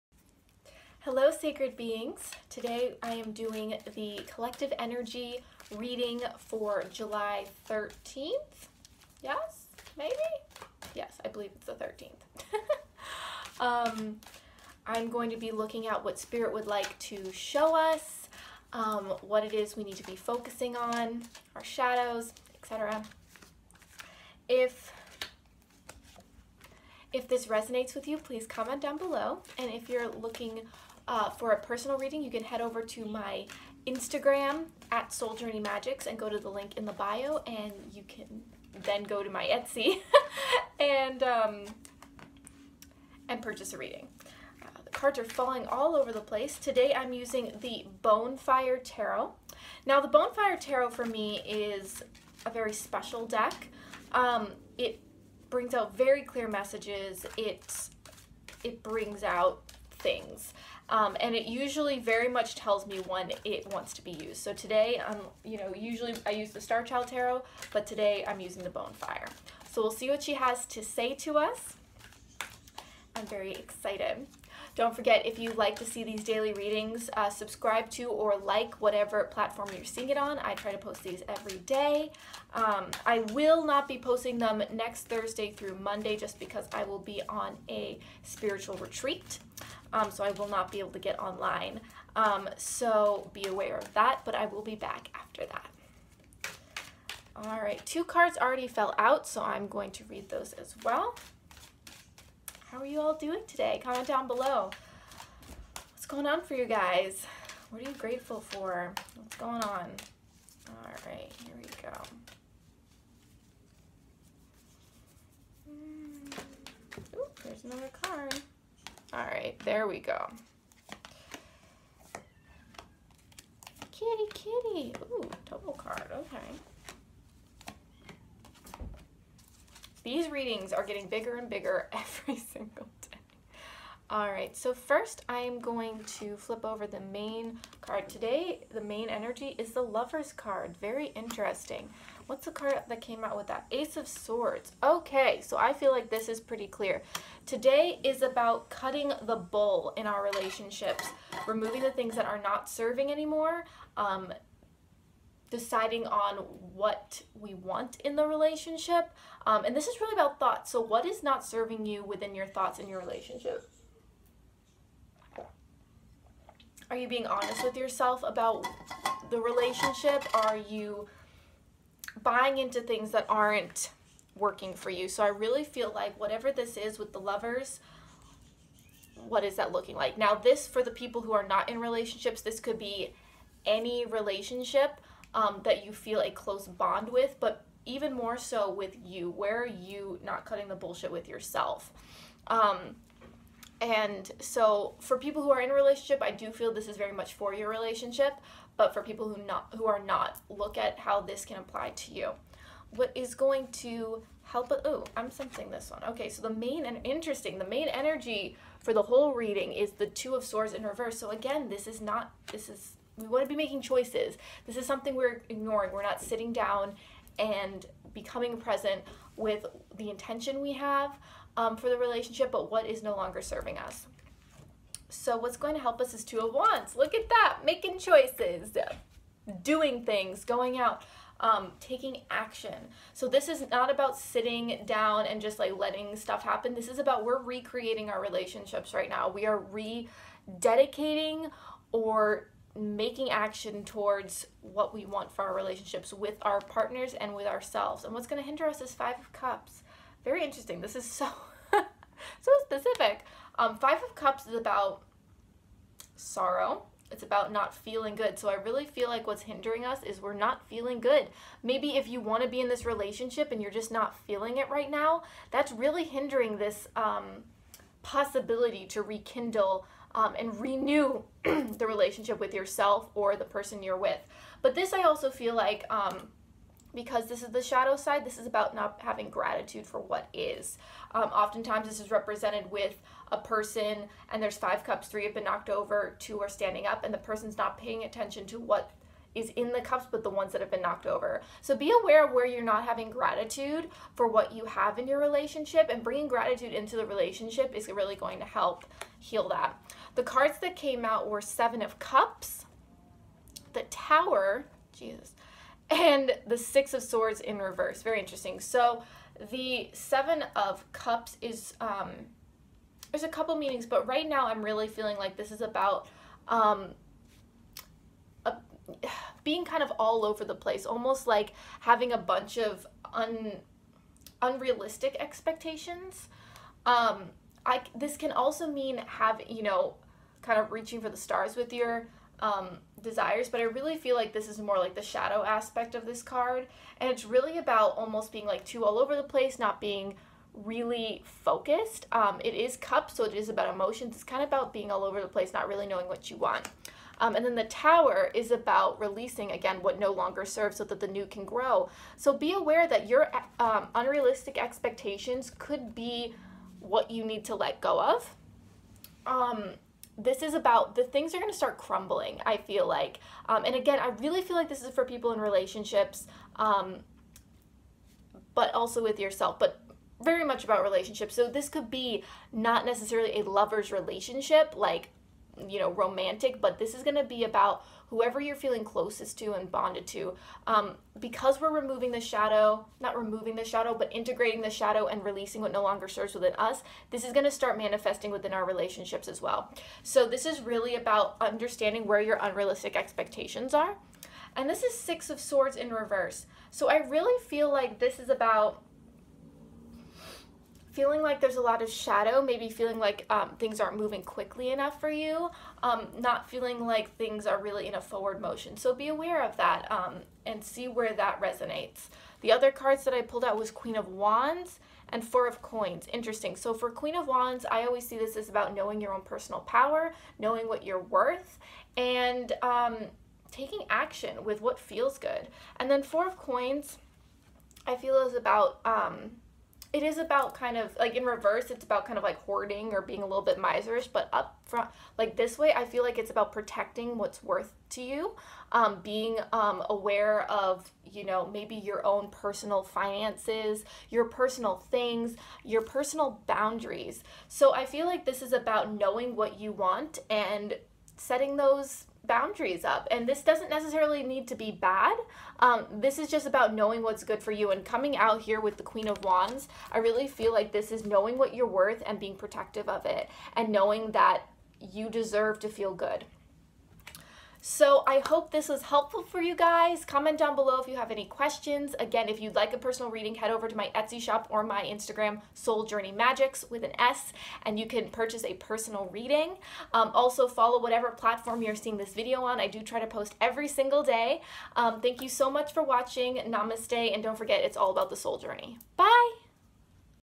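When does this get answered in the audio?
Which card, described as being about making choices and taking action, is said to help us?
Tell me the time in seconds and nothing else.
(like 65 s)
226 s.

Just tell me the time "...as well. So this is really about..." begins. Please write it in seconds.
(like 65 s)
389 s.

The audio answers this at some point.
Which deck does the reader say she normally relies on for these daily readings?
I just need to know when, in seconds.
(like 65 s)
66 s.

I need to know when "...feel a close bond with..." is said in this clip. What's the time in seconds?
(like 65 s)
185 s.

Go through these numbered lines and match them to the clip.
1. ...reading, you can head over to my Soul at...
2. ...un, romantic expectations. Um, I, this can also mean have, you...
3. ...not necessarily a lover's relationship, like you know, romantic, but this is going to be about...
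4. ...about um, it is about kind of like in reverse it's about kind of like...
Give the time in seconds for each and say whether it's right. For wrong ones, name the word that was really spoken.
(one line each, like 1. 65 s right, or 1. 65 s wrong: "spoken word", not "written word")
1. 31 s wrong: "Instagram", not "Soul"
2. 323 s wrong: "unrealistic", not "romantic"
3. 372 s right
4. 428 s right.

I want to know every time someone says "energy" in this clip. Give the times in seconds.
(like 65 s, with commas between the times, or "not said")
4 s, 139 s, 207 s.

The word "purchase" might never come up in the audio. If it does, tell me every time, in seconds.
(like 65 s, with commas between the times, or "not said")
43 s, 478 s.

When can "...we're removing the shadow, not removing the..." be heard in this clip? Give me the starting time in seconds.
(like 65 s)
381 s.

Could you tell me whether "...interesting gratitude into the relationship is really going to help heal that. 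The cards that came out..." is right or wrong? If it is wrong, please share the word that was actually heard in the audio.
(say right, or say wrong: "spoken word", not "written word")
wrong: "bringing", not "interesting".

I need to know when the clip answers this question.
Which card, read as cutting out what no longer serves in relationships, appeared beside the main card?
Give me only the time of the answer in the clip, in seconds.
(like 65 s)
143 s.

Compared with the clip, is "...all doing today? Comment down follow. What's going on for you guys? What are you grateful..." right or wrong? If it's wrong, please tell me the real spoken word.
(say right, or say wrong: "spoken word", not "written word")
wrong: "below", not "follow".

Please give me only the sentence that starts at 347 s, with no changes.
Um, and then the tower is about releasing again what no longer serves so that the new can grow.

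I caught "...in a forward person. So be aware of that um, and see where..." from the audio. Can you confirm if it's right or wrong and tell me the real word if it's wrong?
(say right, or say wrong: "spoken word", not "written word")
wrong: "motion", not "person".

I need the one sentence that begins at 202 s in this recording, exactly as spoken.
What is going to help oh, I'm sensing this one.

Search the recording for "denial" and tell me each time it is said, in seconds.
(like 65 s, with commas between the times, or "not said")
not said.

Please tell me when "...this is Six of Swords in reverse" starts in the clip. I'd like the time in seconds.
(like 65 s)
394 s.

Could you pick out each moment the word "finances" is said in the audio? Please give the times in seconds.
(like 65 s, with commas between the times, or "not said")
442 s.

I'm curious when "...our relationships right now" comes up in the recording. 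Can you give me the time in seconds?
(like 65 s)
238 s.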